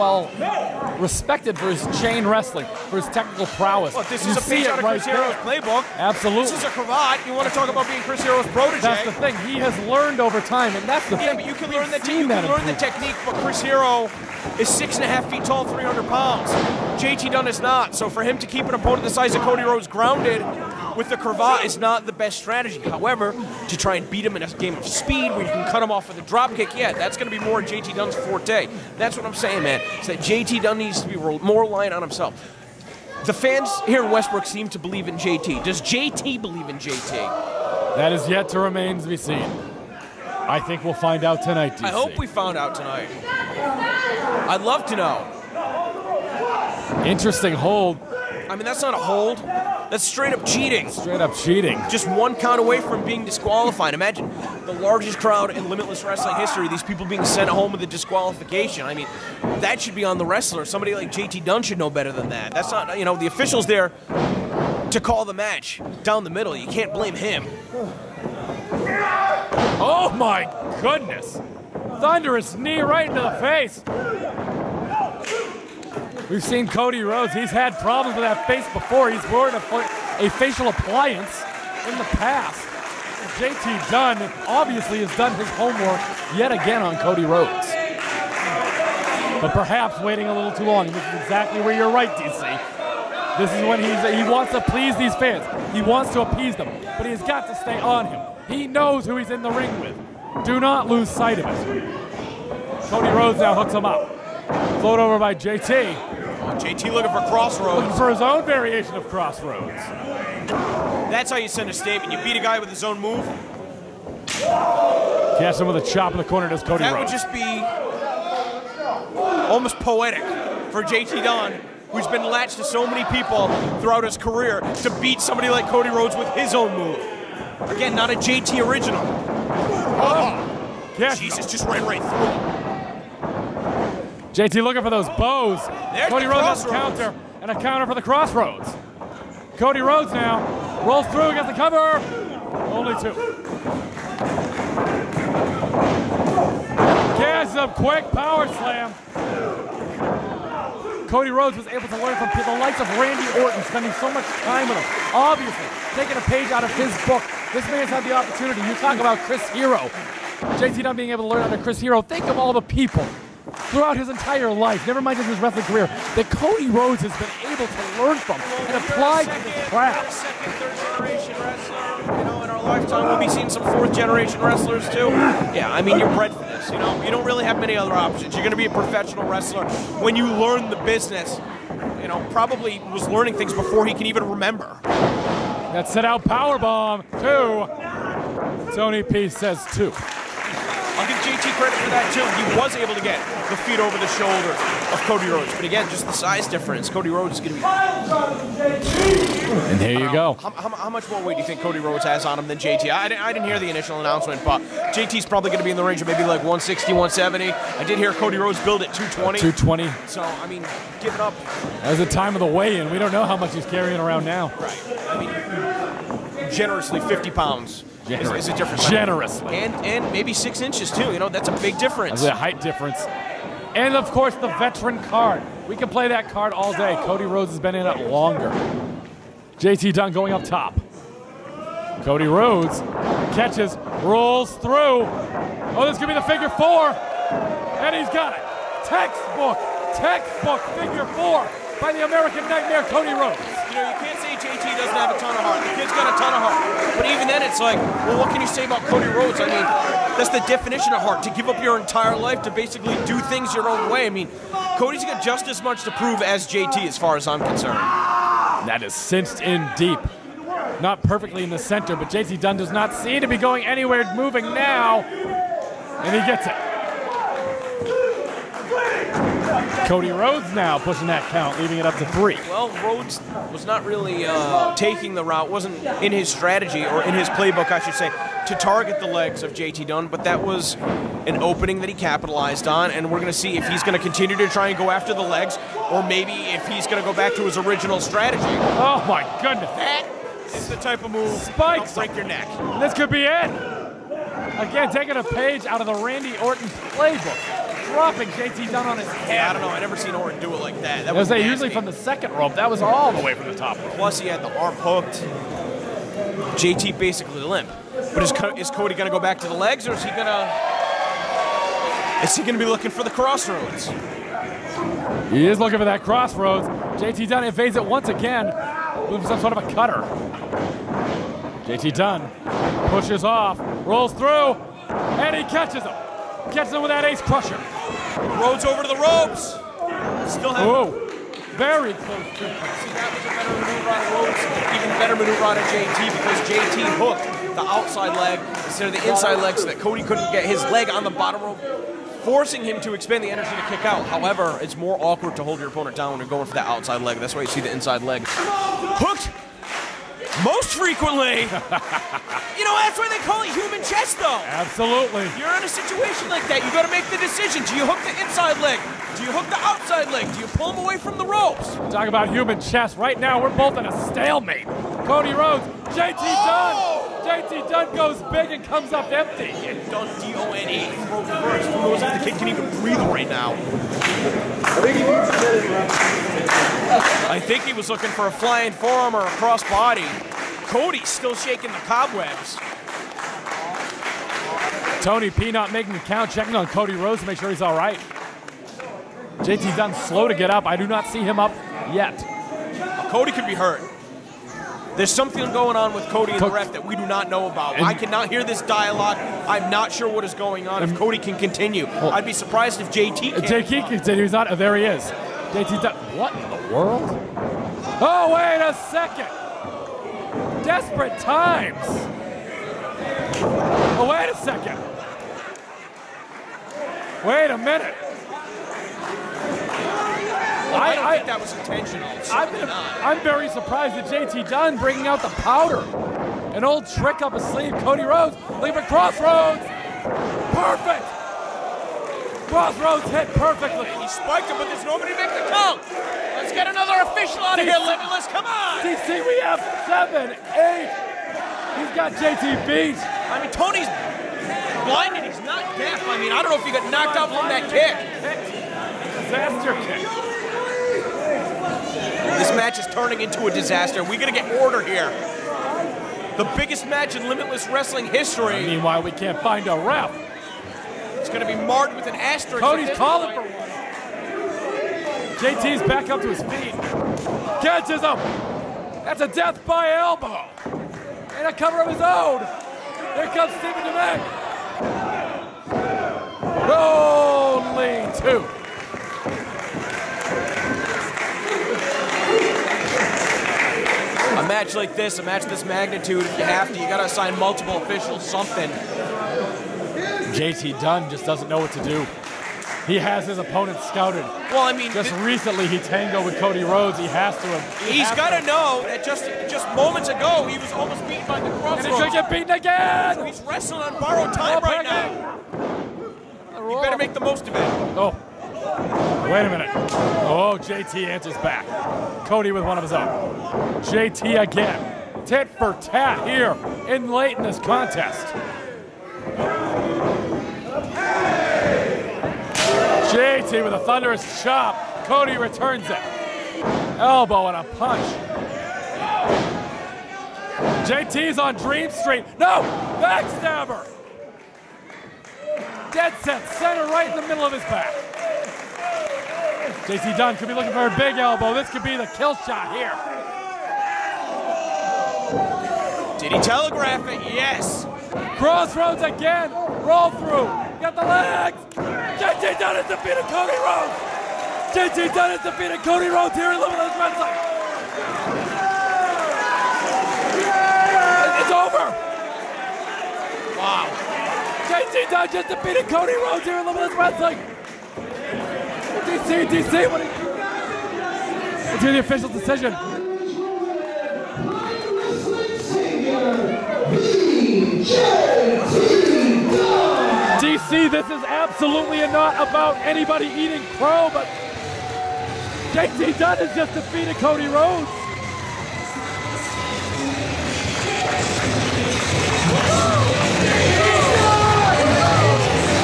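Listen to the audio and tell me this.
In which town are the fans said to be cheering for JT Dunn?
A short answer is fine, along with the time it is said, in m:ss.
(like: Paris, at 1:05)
Westbrook, at 0:34.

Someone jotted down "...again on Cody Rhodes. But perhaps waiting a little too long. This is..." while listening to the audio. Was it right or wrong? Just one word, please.
right.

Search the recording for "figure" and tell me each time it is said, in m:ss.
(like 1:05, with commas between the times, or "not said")
3:56, 4:00.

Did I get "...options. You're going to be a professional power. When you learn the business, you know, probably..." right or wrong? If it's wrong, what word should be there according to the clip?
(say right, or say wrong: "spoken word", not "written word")
wrong: "wrestler", not "power".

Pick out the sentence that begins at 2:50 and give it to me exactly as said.
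third generation wrestler, you know, in our lifetime we'll be seeing some fourth generation wrestlers too.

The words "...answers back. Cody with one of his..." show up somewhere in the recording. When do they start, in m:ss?
8:31.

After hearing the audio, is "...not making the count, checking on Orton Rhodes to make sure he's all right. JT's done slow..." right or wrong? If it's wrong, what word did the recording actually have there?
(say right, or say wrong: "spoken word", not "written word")
wrong: "Cody", not "Orton".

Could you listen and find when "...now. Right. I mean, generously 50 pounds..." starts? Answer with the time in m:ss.
3:34.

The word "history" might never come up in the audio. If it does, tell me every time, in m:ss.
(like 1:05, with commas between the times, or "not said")
0:56, 7:38.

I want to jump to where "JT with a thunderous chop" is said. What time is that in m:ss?
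8:43.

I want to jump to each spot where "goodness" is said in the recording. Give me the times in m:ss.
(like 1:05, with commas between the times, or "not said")
1:10, 4:49.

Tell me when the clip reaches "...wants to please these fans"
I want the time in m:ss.
1:34.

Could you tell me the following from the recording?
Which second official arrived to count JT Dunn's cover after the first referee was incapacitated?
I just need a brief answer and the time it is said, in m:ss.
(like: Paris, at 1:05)
Stephen Devane, at 7:53.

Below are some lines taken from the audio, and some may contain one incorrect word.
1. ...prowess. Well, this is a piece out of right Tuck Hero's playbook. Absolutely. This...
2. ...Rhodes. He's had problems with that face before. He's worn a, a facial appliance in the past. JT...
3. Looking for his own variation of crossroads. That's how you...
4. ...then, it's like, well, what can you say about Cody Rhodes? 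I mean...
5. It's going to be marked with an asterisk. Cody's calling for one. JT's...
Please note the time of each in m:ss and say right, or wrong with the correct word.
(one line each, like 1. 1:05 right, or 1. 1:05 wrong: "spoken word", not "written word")
1. 0:03 wrong: "Chris", not "Tuck"
2. 1:17 right
3. 1:47 right
4. 4:07 right
5. 7:41 right.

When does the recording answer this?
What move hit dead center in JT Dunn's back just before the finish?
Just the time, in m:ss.
8:52.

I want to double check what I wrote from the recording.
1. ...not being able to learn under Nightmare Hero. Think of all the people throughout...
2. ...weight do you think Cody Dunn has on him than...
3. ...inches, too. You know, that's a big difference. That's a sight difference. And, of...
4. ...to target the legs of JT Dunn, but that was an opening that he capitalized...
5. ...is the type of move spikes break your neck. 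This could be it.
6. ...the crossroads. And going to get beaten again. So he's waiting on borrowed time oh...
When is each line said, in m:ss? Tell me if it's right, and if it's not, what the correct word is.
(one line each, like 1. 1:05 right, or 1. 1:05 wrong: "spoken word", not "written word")
1. 2:40 wrong: "Chris", not "Nightmare"
2. 3:21 wrong: "Rhodes", not "Dunn"
3. 3:40 wrong: "height", not "sight"
4. 4:38 right
5. 4:50 right
6. 8:21 wrong: "wrestling", not "waiting".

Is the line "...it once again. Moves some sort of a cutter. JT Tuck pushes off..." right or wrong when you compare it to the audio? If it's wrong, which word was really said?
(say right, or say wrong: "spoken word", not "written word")
wrong: "Dunn", not "Tuck".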